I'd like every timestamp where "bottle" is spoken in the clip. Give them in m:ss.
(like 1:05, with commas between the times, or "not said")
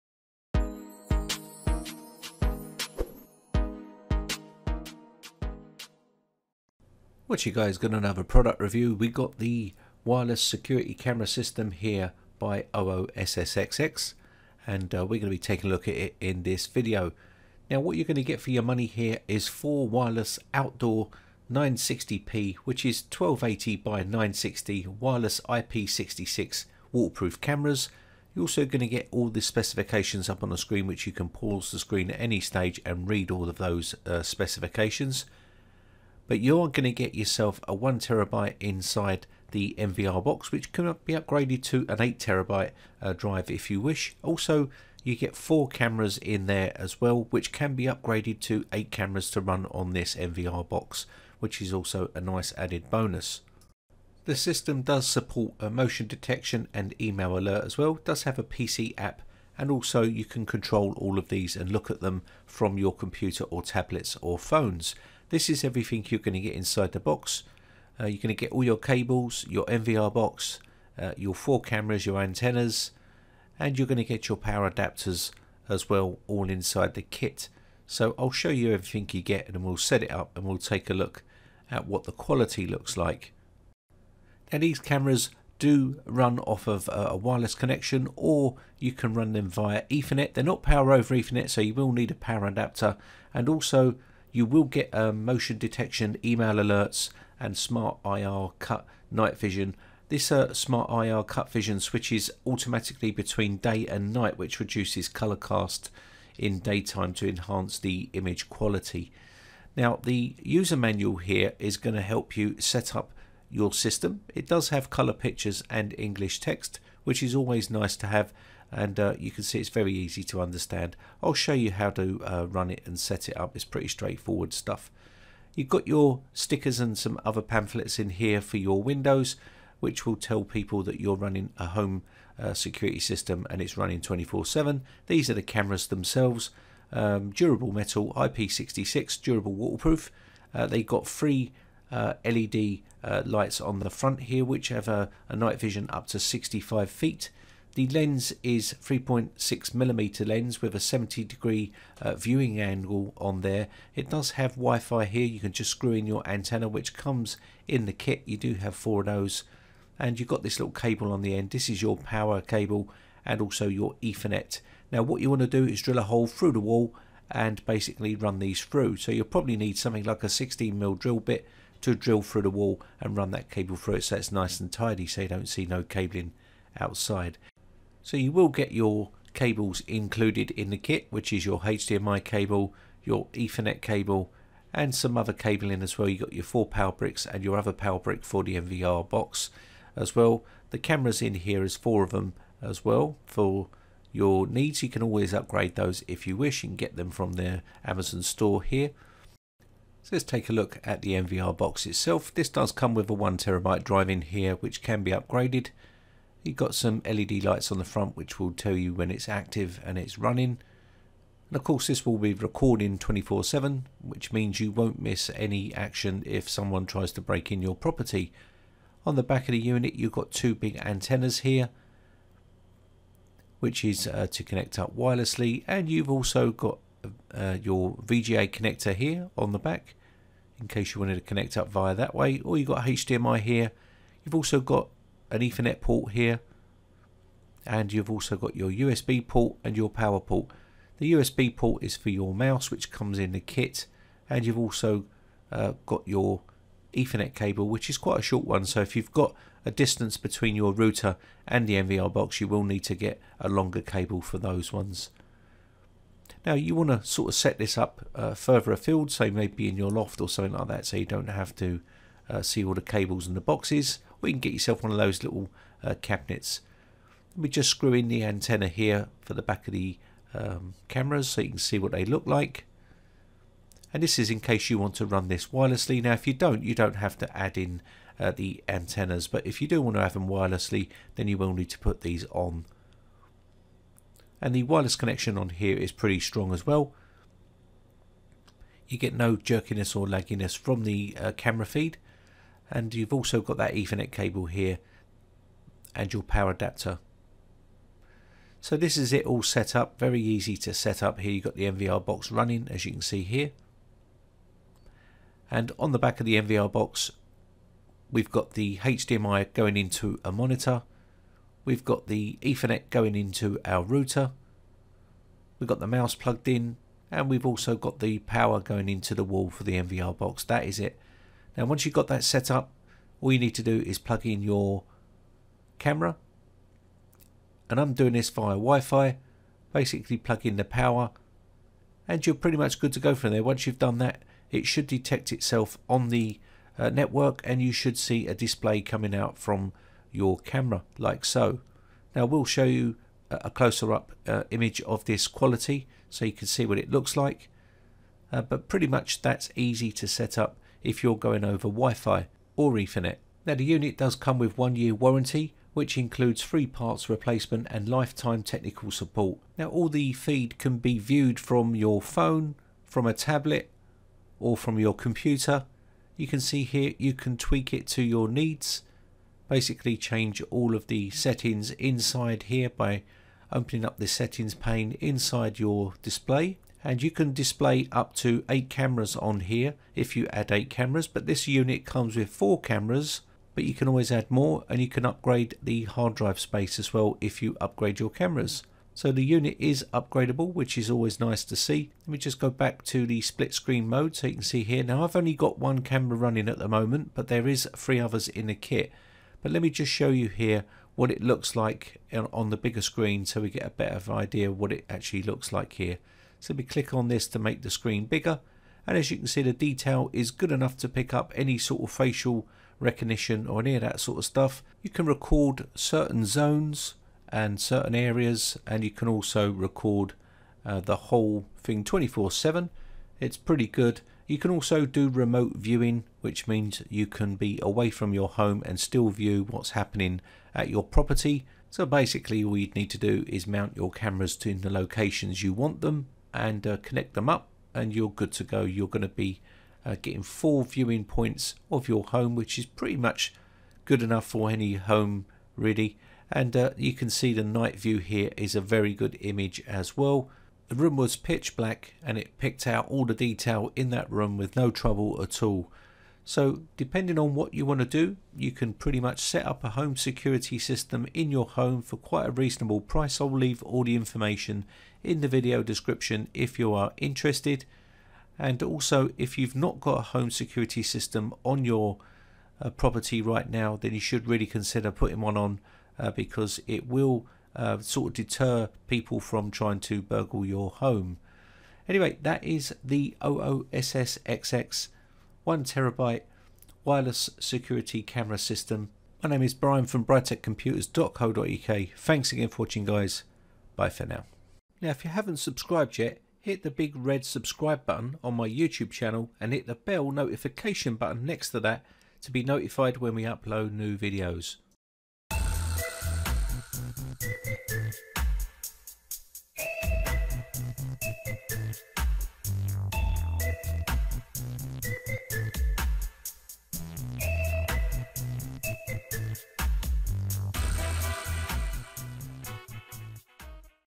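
not said.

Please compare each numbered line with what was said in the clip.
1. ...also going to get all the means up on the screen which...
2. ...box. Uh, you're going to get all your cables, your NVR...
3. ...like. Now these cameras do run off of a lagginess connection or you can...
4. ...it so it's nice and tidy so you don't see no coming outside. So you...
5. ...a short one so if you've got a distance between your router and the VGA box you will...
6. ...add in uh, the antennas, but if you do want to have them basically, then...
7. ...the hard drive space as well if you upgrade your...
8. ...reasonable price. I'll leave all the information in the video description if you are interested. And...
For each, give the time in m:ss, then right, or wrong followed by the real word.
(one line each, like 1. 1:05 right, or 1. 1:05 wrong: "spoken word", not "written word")
1. 0:28 wrong: "specifications", not "means"
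2. 1:06 right
3. 1:22 wrong: "wireless", not "lagginess"
4. 2:53 wrong: "cabling", not "coming"
5. 4:08 wrong: "NVR", not "VGA"
6. 4:37 wrong: "wirelessly", not "basically"
7. 6:25 right
8. 7:42 right.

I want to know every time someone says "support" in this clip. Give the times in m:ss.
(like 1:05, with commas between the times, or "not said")
0:55, 5:58.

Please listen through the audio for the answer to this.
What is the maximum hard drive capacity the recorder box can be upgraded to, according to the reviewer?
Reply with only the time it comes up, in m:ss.
0:42.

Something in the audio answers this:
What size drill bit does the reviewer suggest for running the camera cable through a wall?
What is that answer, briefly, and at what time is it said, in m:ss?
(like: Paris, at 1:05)
16 mil, at 2:50.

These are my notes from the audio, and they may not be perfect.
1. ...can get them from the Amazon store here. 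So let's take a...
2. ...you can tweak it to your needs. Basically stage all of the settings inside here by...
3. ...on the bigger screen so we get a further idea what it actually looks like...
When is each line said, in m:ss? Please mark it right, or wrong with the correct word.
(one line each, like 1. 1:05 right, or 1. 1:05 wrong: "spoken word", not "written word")
1. 3:16 right
2. 6:06 wrong: "change", not "stage"
3. 6:42 wrong: "better", not "further".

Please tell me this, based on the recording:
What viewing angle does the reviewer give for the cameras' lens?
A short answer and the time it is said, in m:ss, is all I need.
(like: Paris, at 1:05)
70 degree, at 2:30.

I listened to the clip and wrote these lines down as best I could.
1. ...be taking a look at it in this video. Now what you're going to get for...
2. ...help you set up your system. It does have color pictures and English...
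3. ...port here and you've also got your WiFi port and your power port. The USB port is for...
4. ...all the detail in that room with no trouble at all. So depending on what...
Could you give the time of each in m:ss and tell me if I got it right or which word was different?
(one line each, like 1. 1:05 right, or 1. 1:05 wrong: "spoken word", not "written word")
1. 0:15 right
2. 1:52 right
3. 3:55 wrong: "USB", not "WiFi"
4. 7:32 right.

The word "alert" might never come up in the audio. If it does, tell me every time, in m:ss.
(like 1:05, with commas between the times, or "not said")
0:57, 1:36.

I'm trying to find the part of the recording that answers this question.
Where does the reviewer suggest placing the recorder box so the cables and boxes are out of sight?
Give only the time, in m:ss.
4:19.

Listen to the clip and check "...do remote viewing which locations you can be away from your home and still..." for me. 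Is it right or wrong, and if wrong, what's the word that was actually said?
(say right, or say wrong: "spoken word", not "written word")
wrong: "means", not "locations".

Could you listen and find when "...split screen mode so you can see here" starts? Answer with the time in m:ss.
6:33.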